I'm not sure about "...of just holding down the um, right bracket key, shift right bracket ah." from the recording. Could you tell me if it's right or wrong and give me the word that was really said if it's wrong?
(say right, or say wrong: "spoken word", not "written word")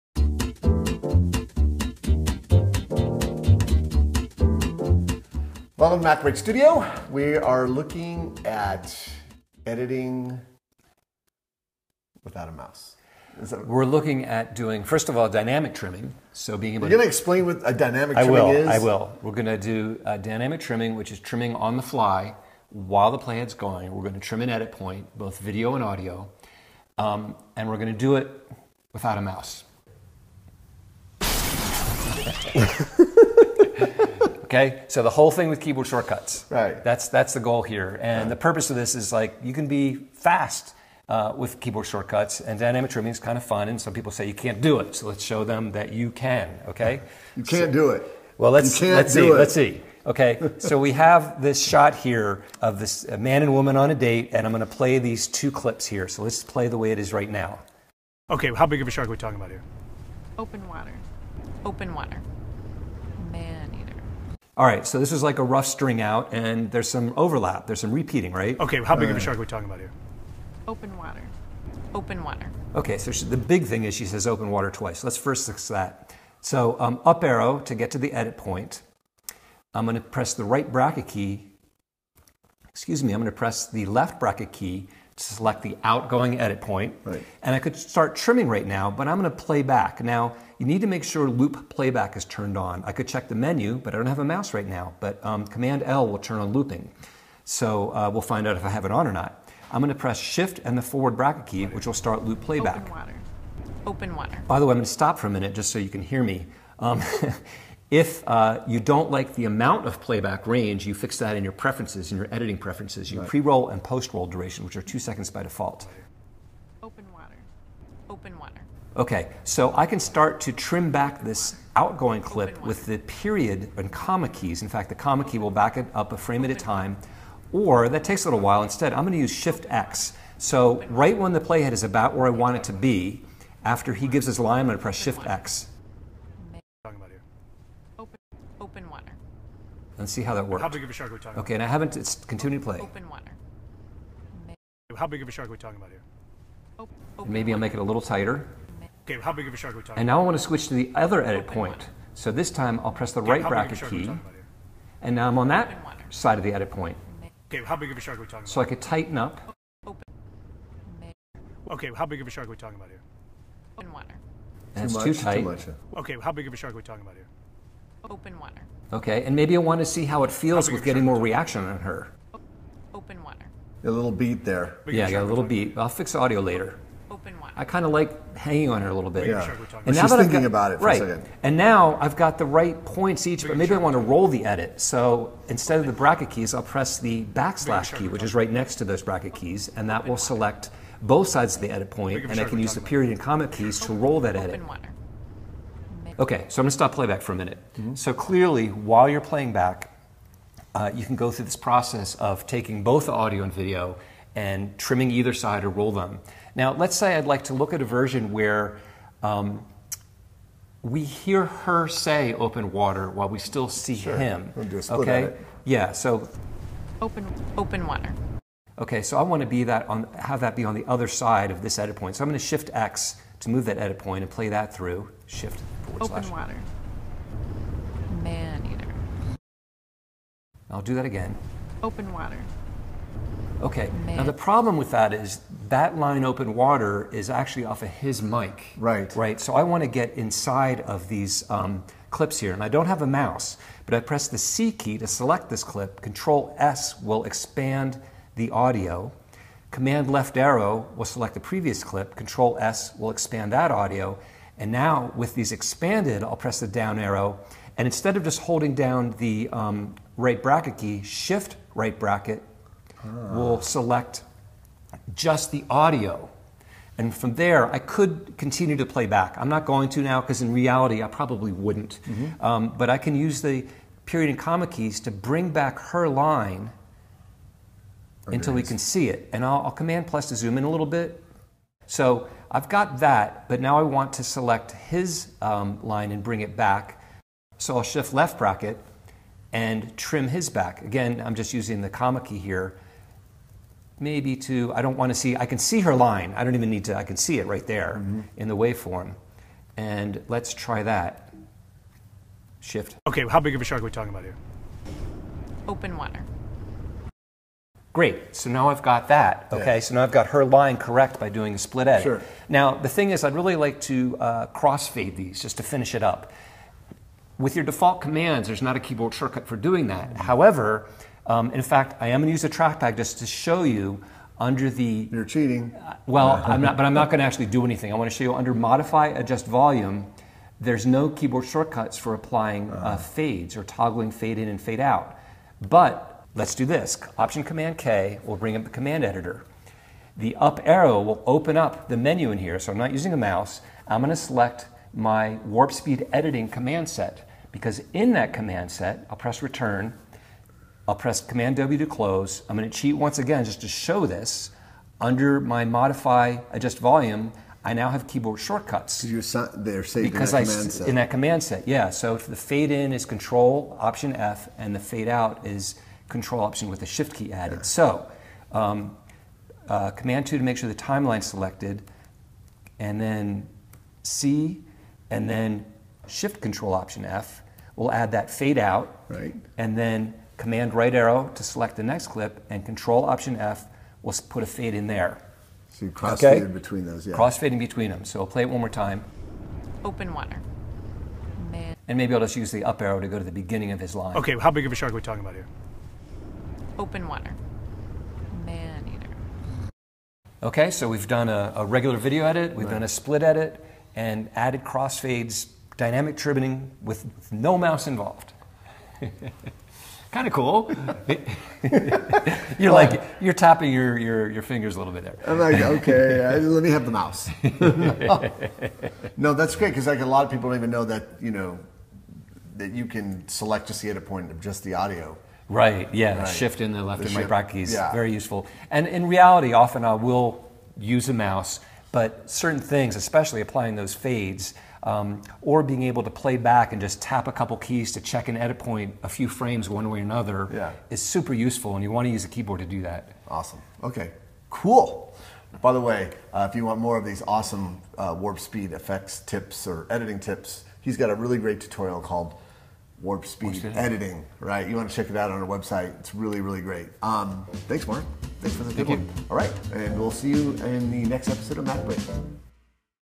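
right.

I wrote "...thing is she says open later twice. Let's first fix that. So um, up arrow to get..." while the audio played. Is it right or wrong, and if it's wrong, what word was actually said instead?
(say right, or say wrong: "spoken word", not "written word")
wrong: "water", not "later".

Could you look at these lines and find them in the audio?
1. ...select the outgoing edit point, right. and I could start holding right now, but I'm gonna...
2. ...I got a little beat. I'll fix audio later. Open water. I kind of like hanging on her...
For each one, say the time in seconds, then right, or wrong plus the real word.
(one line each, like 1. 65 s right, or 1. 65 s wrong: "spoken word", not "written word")
1. 85 s wrong: "trimming", not "holding"
2. 175 s right.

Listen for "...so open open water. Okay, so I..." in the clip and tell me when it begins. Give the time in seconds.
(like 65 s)
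215 s.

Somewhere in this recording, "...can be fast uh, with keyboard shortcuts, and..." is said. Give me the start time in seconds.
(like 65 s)
39 s.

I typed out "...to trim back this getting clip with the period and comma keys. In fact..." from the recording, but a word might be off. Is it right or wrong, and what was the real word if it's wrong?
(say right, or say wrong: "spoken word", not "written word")
wrong: "outgoing", not "getting".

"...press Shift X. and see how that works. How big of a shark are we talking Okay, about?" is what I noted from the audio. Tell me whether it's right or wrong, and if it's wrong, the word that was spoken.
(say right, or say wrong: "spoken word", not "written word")
right.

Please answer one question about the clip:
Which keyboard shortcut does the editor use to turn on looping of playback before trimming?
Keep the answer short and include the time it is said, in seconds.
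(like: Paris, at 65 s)
Command L, at 95 s.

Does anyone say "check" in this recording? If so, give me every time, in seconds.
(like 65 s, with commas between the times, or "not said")
93 s, 438 s, 454 s.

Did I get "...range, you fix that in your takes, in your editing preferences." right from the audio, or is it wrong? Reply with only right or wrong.
wrong.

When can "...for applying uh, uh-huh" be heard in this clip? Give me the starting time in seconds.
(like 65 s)
331 s.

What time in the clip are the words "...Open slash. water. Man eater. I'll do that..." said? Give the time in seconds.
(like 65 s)
226 s.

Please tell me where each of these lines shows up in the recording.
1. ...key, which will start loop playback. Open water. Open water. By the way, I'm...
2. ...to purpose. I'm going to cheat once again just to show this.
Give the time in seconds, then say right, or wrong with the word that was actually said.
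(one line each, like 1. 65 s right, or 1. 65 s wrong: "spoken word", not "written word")
1. 101 s right
2. 351 s wrong: "close", not "purpose".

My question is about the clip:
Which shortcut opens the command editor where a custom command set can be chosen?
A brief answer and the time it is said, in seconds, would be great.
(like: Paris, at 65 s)
Option Command K, at 337 s.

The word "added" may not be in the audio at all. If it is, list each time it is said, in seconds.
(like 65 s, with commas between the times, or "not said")
367 s, 404 s.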